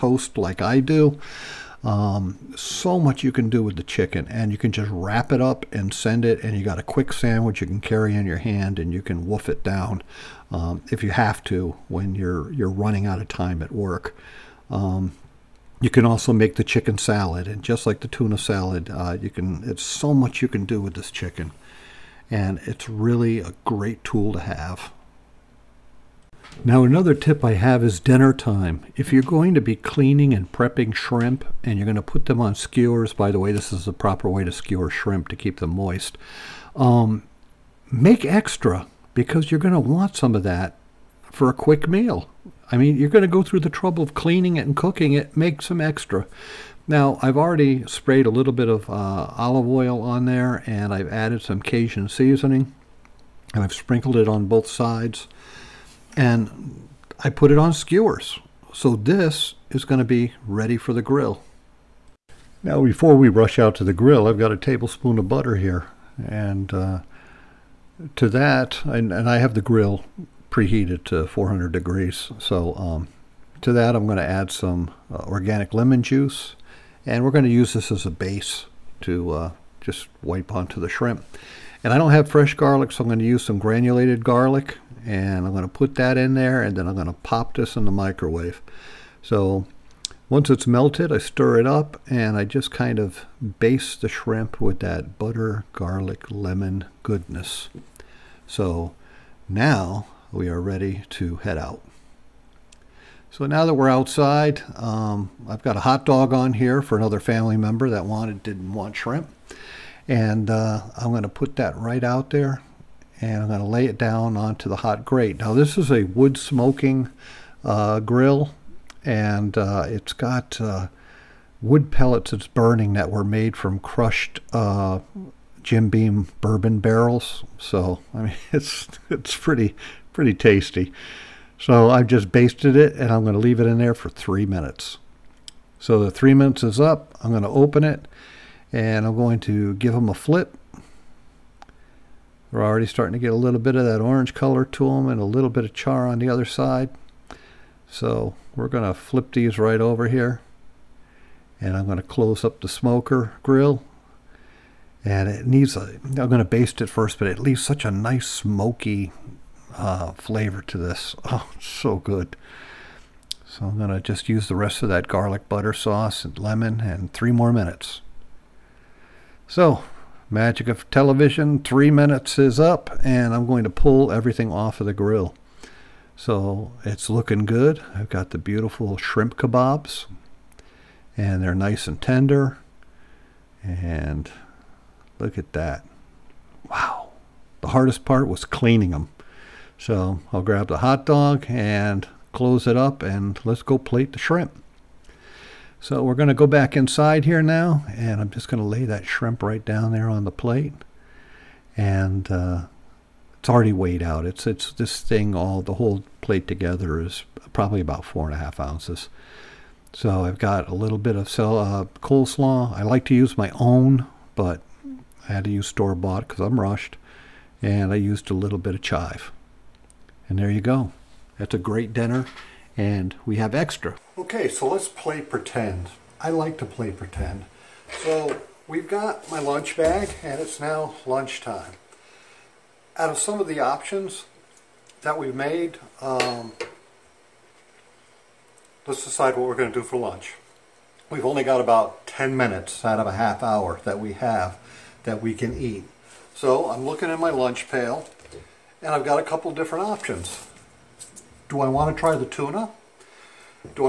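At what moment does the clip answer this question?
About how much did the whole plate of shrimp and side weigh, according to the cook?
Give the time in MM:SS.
03:28.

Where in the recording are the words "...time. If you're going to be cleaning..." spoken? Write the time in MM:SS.
00:28.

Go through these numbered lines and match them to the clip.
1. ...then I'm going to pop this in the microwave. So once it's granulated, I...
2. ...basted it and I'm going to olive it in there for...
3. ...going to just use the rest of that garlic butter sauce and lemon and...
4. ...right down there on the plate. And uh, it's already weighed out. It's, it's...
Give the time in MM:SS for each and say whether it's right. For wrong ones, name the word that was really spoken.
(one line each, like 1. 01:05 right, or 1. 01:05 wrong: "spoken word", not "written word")
1. 01:26 wrong: "melted", not "granulated"
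2. 02:12 wrong: "leave", not "olive"
3. 02:43 right
4. 03:19 right.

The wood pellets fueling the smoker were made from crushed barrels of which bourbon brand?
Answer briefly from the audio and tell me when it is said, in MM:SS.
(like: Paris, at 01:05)
Jim Beam, at 02:05.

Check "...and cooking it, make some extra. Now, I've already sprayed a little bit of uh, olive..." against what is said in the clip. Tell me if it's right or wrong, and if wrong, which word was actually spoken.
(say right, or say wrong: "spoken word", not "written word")
right.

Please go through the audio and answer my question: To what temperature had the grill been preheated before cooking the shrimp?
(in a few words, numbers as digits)
400 degrees.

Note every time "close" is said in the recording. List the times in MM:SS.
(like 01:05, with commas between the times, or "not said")
02:32, 03:12.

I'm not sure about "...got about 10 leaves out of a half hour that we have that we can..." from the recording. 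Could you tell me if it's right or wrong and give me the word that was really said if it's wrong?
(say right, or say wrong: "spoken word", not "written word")
wrong: "minutes", not "leaves".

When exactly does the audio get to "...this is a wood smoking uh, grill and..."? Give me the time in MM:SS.
01:55.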